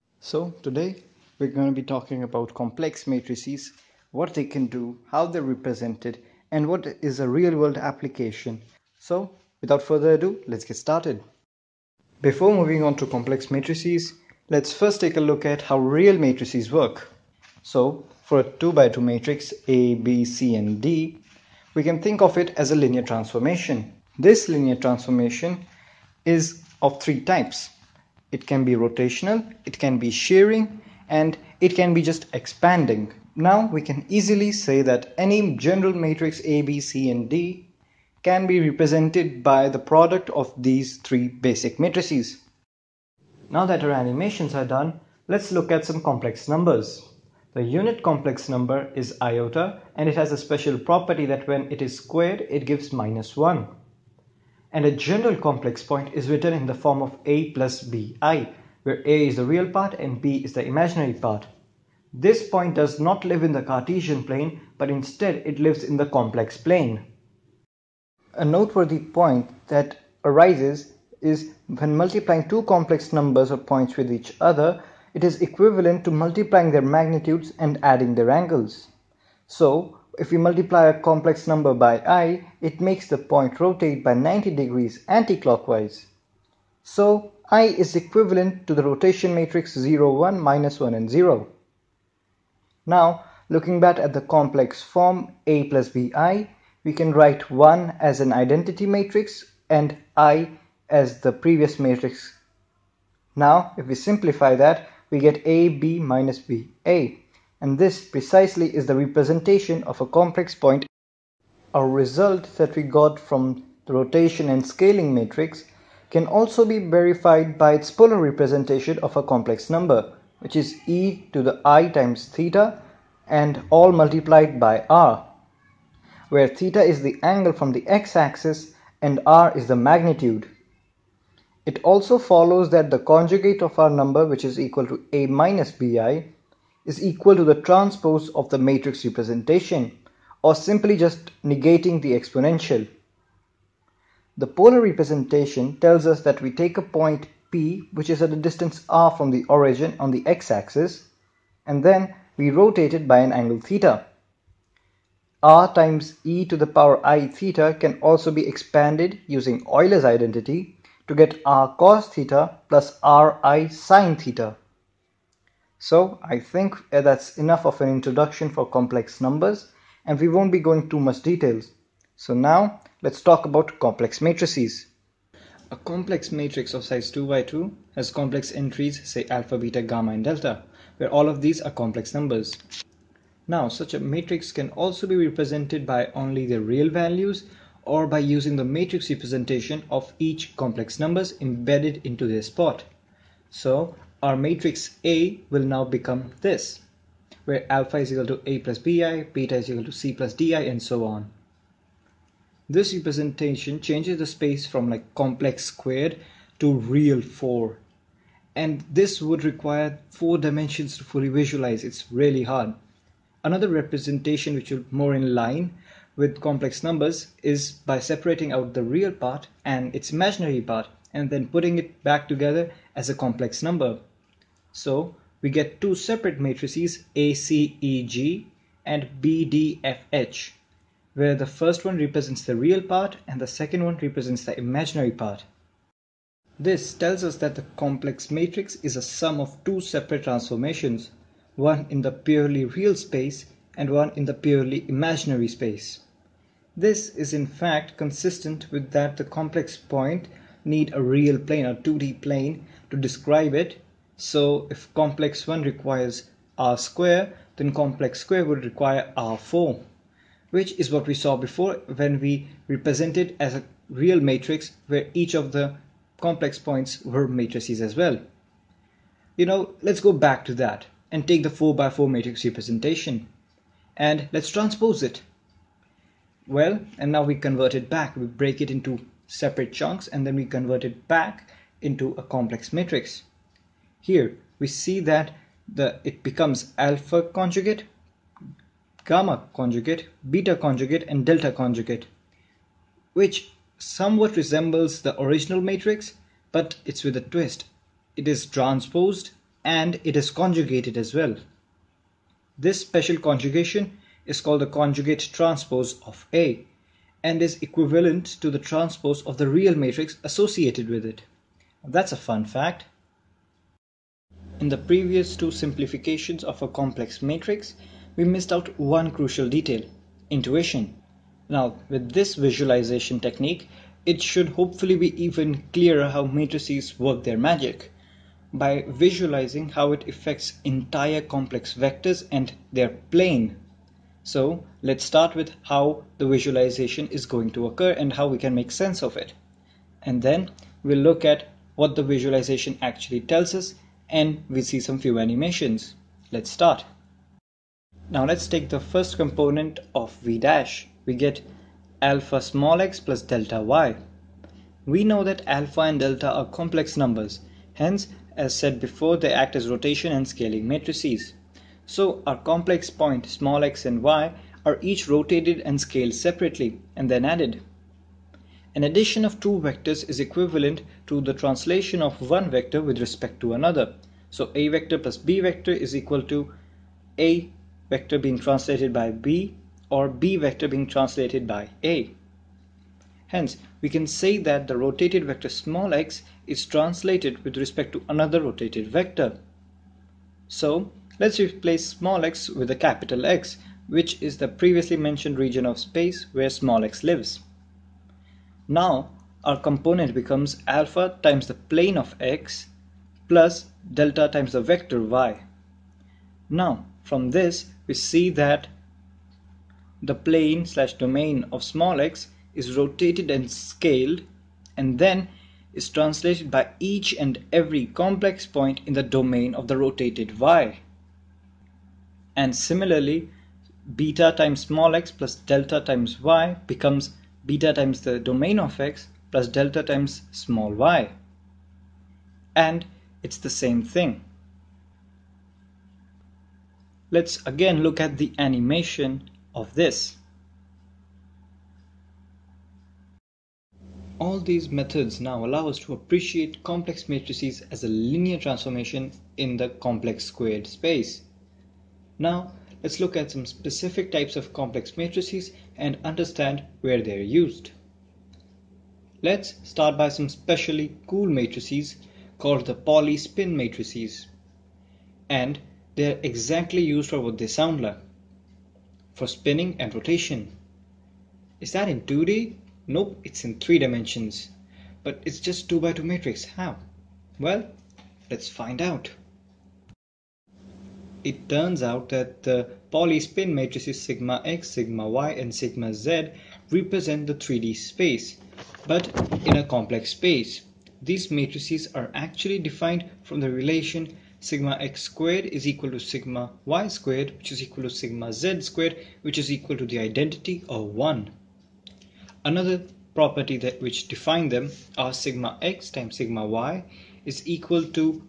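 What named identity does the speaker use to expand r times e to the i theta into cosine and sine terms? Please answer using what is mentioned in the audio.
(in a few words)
Euler's identity.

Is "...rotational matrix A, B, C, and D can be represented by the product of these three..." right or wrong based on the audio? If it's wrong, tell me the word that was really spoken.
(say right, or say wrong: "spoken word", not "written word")
wrong: "general", not "rotational".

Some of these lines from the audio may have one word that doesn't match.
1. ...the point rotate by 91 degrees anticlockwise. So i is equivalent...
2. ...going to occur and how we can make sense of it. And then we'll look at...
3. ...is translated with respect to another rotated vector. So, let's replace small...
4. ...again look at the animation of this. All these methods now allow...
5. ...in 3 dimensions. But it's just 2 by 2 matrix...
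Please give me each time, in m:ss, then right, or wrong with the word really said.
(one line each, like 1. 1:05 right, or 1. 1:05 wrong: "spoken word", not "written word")
1. 1:23 wrong: "90", not "91"
2. 5:37 right
3. 6:26 right
4. 7:17 right
5. 7:53 right.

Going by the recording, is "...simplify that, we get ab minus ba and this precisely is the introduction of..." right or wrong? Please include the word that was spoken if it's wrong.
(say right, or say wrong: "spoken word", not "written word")
wrong: "representation", not "introduction".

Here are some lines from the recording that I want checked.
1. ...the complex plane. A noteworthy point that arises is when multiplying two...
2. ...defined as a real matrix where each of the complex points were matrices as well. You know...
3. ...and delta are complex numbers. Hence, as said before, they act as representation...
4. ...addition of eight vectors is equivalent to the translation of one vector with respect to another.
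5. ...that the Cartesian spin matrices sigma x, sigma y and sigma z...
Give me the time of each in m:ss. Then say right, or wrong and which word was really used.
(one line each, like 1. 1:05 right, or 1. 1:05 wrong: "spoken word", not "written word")
1. 1:05 right
2. 4:22 wrong: "represented", not "defined"
3. 5:55 wrong: "rotation", not "representation"
4. 6:08 wrong: "two", not "eight"
5. 8:02 wrong: "Pauli", not "Cartesian".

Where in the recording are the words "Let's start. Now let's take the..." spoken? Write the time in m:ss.
5:46.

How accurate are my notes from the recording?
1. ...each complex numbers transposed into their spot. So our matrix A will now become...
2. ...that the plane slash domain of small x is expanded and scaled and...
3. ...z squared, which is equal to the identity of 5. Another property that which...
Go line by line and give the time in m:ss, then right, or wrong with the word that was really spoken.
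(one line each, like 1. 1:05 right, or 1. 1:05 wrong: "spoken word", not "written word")
1. 3:10 wrong: "embedded", not "transposed"
2. 6:48 wrong: "rotated", not "expanded"
3. 8:18 wrong: "1", not "5".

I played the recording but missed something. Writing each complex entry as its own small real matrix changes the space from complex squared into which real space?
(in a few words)
Real 4.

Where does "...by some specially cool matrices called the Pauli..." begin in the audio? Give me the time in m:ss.
7:39.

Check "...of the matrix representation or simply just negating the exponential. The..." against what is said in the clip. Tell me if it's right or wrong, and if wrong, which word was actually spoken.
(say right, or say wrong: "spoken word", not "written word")
right.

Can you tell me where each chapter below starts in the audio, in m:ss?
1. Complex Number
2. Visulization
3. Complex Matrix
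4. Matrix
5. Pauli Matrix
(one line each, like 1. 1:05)
1. 0:44
2. 5:14
3. 2:49
4. 0:10
5. 7:32.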